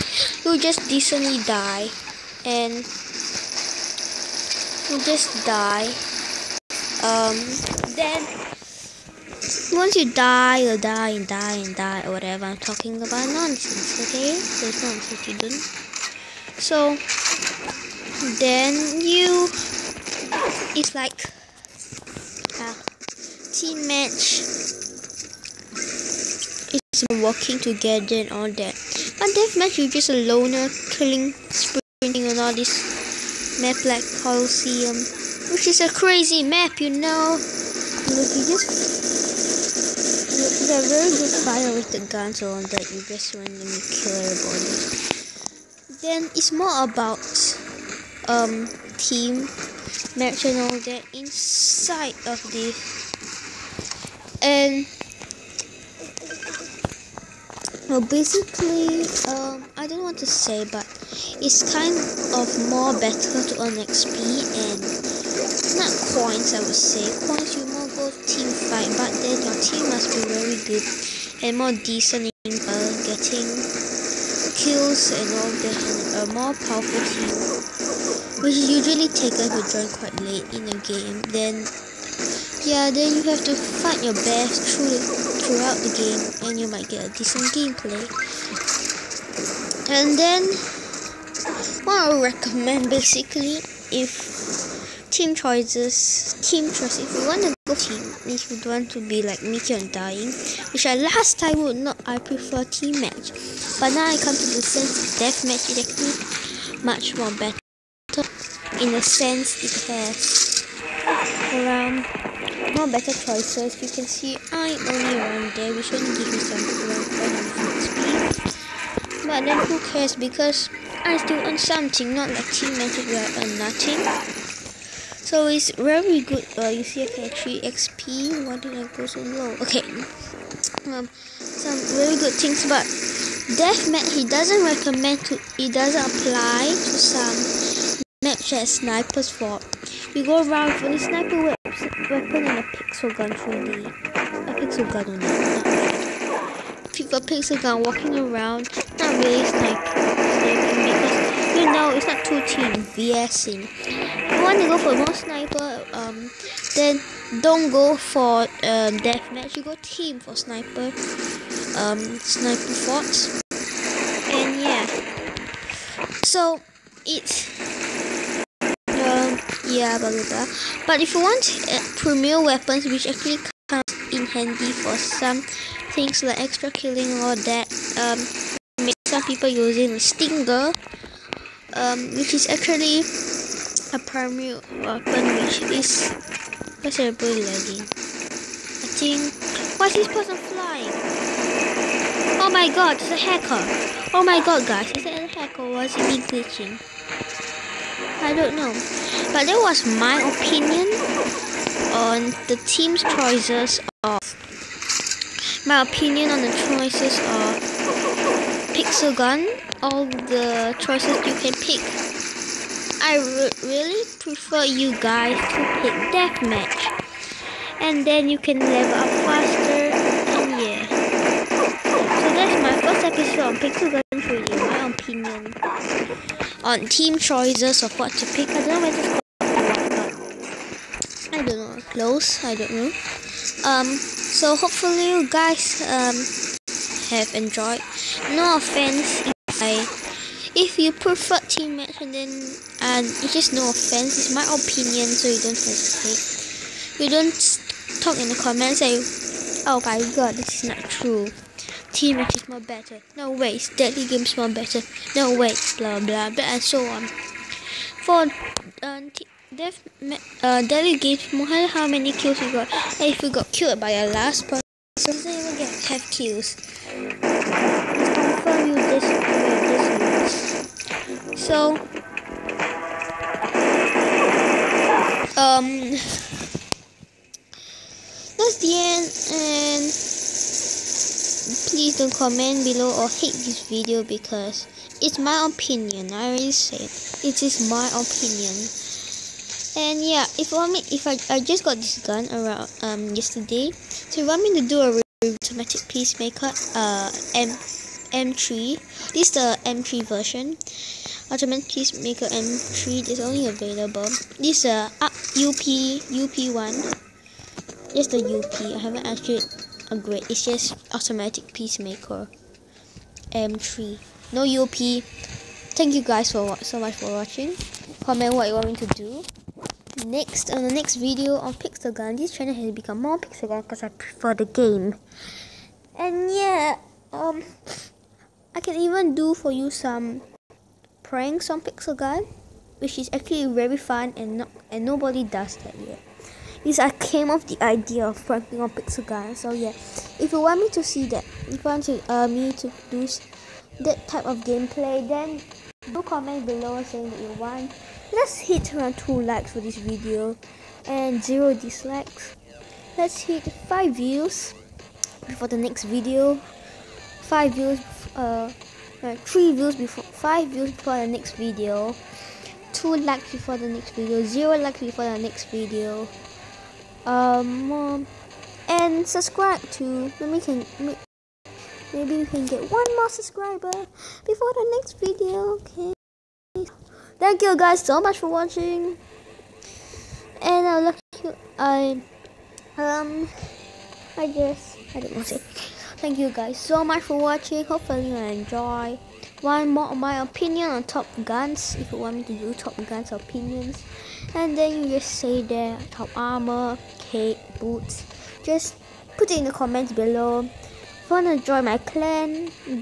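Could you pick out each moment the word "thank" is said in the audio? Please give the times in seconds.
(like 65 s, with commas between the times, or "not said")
315 s, 377 s, 386 s.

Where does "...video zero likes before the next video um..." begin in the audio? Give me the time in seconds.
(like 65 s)
363 s.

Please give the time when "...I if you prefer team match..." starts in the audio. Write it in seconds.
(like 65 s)
239 s.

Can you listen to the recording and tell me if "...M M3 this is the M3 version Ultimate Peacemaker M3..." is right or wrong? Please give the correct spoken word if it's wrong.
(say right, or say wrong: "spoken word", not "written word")
right.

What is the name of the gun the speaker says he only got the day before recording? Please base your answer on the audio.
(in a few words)
Automatic Peacemaker M3.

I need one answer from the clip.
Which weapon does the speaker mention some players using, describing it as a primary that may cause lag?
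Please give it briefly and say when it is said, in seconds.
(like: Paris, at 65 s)
stinger, at 179 s.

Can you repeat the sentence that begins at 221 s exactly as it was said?
So that's my first episode on Pixel Gun 3D.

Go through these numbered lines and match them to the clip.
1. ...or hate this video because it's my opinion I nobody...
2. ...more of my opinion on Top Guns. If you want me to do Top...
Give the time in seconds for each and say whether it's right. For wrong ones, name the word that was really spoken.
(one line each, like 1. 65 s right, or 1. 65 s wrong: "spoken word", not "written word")
1. 283 s wrong: "already", not "nobody"
2. 389 s right.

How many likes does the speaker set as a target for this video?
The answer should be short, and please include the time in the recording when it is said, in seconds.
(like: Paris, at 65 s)
2, at 348 s.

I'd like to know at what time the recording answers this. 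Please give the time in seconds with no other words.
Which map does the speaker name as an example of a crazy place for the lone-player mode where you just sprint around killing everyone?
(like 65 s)
34 s.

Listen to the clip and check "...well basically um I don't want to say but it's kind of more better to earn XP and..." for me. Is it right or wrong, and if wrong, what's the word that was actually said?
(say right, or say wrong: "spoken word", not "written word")
right.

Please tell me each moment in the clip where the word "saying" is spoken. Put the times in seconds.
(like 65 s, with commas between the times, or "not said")
346 s.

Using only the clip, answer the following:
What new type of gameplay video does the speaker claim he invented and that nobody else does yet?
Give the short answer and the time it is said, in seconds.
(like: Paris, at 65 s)
pranks on gun, at 331 s.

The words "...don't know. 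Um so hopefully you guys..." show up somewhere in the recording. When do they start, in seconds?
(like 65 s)
232 s.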